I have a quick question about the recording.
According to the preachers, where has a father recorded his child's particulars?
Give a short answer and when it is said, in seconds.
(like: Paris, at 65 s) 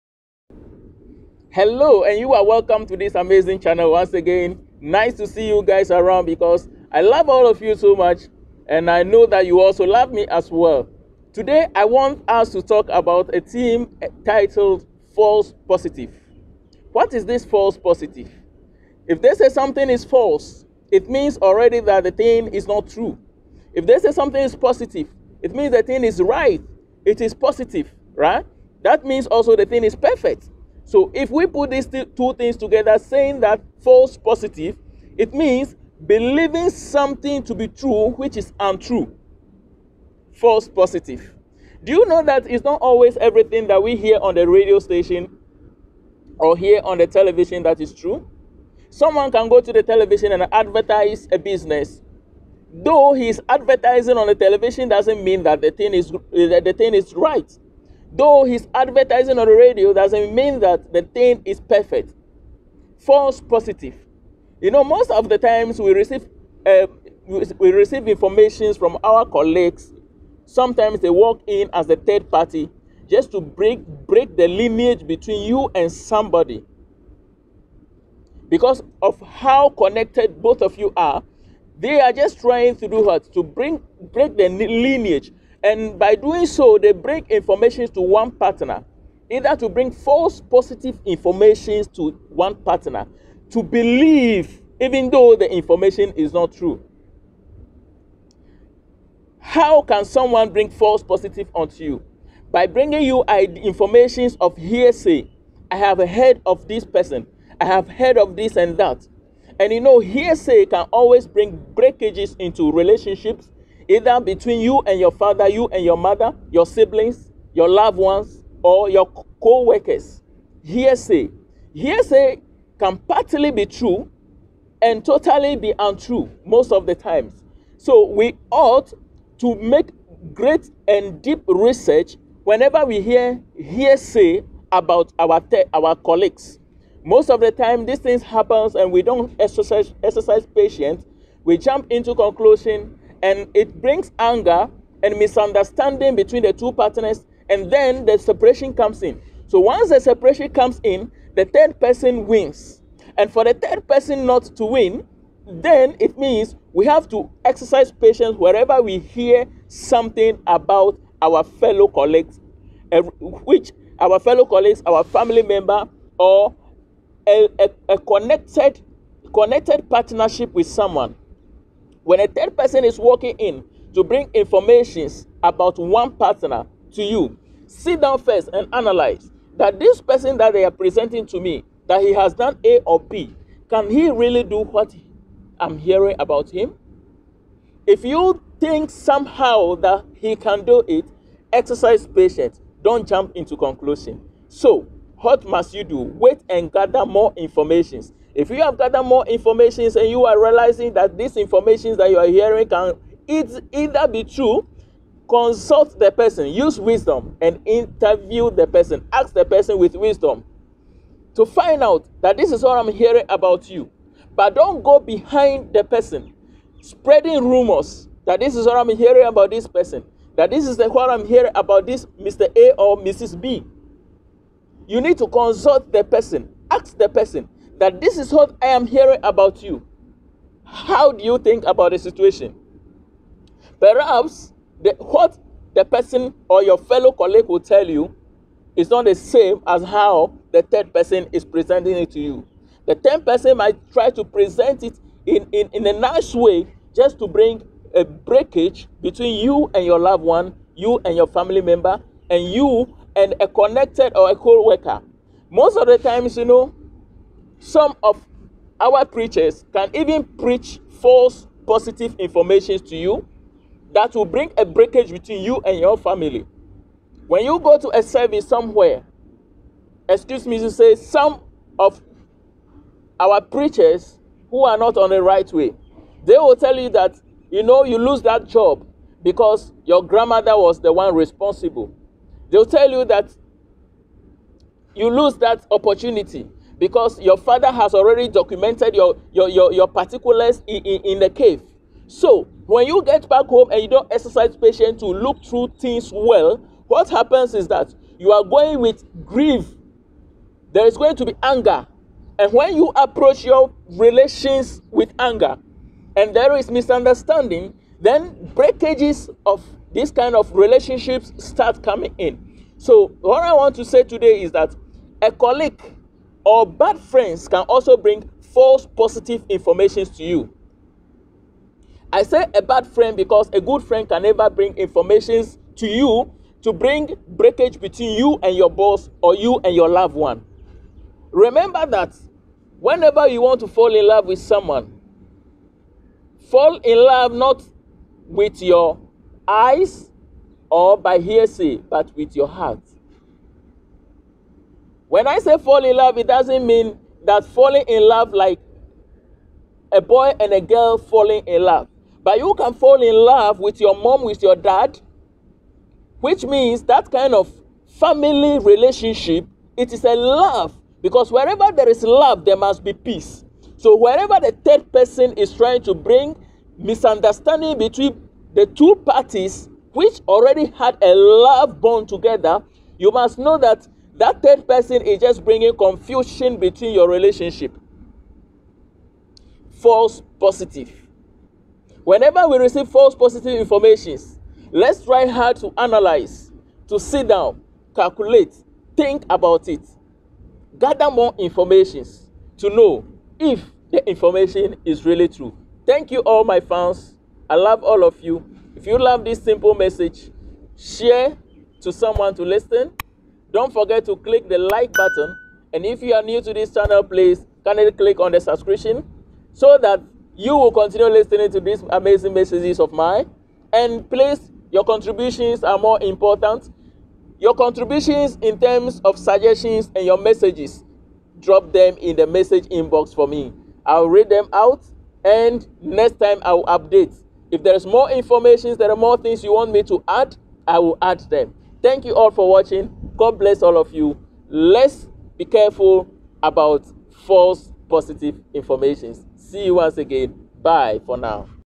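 In the cave, at 291 s.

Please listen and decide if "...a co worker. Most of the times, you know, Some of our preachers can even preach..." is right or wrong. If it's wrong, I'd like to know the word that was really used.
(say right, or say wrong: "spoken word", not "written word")
right.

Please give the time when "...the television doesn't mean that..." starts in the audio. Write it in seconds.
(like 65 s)
54 s.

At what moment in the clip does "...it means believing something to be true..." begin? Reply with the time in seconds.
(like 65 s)
35 s.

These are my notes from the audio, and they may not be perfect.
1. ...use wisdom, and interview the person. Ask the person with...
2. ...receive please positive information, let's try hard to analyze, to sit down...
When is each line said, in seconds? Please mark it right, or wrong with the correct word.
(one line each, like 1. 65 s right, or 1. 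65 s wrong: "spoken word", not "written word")
1. 206 s right
2. 382 s wrong: "false", not "please".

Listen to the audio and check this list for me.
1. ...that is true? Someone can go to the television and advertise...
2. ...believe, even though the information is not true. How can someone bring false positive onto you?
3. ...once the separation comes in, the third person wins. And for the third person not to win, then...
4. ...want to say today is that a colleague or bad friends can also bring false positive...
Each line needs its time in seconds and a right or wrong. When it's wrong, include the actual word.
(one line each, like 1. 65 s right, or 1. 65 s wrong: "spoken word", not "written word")
1. 47 s right
2. 93 s right
3. 149 s right
4. 313 s right.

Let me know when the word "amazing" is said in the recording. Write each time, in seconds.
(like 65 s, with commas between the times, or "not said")
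3 s, 411 s.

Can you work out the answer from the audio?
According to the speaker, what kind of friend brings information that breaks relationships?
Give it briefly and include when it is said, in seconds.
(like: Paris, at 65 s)
A bad friend, at 322 s.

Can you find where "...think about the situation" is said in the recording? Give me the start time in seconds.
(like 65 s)
231 s.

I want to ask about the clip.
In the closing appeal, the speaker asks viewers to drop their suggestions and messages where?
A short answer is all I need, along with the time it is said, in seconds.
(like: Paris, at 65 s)
The message inbox, at 422 s.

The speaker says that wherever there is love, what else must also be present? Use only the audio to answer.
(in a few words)
Peace.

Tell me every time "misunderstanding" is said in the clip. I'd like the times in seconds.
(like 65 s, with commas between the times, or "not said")
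145 s, 306 s, 366 s.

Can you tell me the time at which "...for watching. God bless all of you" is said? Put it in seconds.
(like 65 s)
432 s.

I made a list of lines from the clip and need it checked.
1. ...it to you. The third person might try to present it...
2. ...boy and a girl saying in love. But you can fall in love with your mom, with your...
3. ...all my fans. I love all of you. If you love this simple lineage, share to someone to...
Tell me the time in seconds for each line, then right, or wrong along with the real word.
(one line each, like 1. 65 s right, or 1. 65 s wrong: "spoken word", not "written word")
1. 241 s right
2. 349 s wrong: "falling", not "saying"
3. 396 s wrong: "message", not "lineage".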